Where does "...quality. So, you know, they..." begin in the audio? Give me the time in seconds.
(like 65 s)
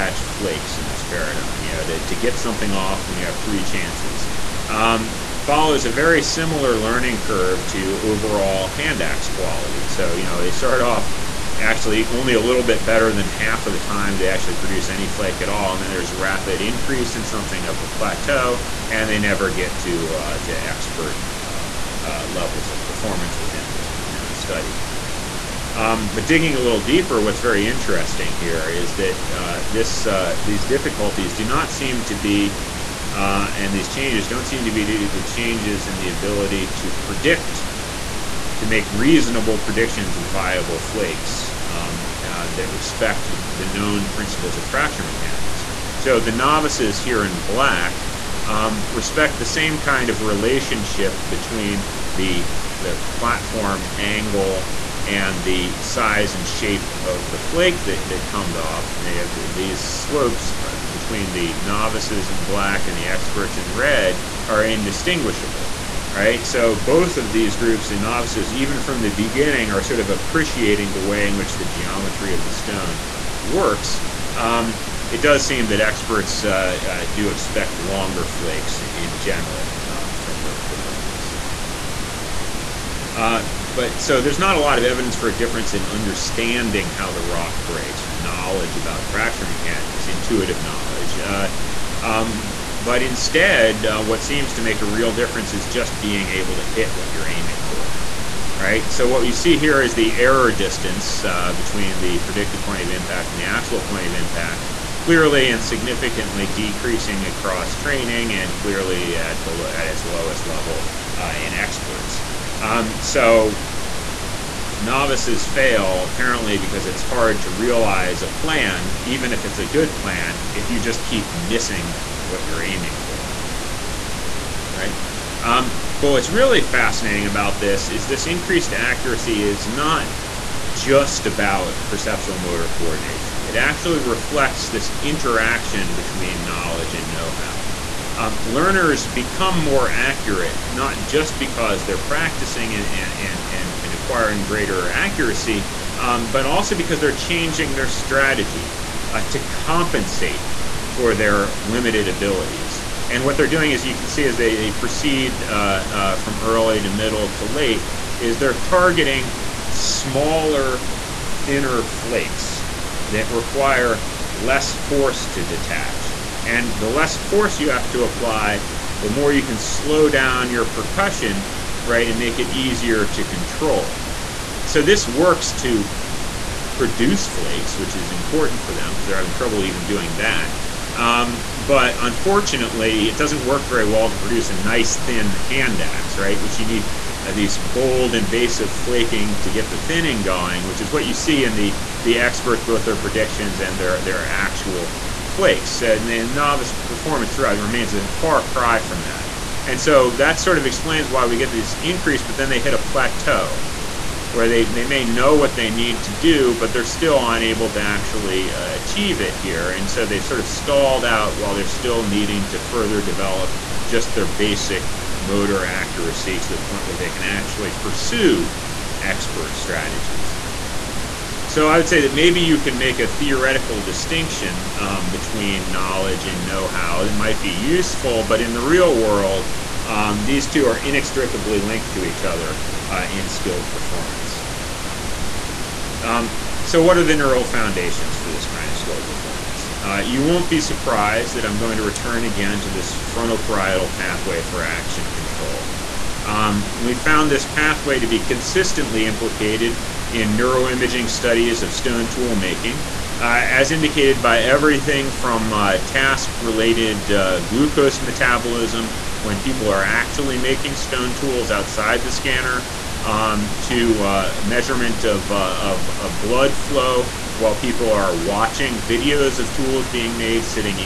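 9 s.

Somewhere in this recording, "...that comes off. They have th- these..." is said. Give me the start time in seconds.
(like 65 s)
58 s.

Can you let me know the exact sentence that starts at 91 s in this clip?
Uh, um, but instead, uh, what seems to make a real difference is just being able to hit what you're aiming for.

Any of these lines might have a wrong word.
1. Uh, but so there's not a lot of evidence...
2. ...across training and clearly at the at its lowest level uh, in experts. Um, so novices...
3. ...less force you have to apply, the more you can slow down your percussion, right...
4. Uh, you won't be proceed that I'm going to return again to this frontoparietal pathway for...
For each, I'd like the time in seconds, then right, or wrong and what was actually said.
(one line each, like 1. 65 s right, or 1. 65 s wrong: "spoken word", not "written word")
1. 83 s right
2. 107 s right
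3. 166 s right
4. 239 s wrong: "surprised", not "proceed".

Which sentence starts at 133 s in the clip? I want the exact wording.
It actually reflects this interaction between knowledge and know how.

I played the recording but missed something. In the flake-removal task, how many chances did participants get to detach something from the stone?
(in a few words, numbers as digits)
3.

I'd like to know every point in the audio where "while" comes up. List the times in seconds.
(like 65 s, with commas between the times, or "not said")
211 s, 267 s.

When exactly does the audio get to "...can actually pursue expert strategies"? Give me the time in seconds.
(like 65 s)
217 s.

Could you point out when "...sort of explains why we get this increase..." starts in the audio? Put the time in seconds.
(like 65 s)
200 s.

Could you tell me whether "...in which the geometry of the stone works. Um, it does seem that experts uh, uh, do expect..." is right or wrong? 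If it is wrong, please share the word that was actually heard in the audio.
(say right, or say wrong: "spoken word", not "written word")
right.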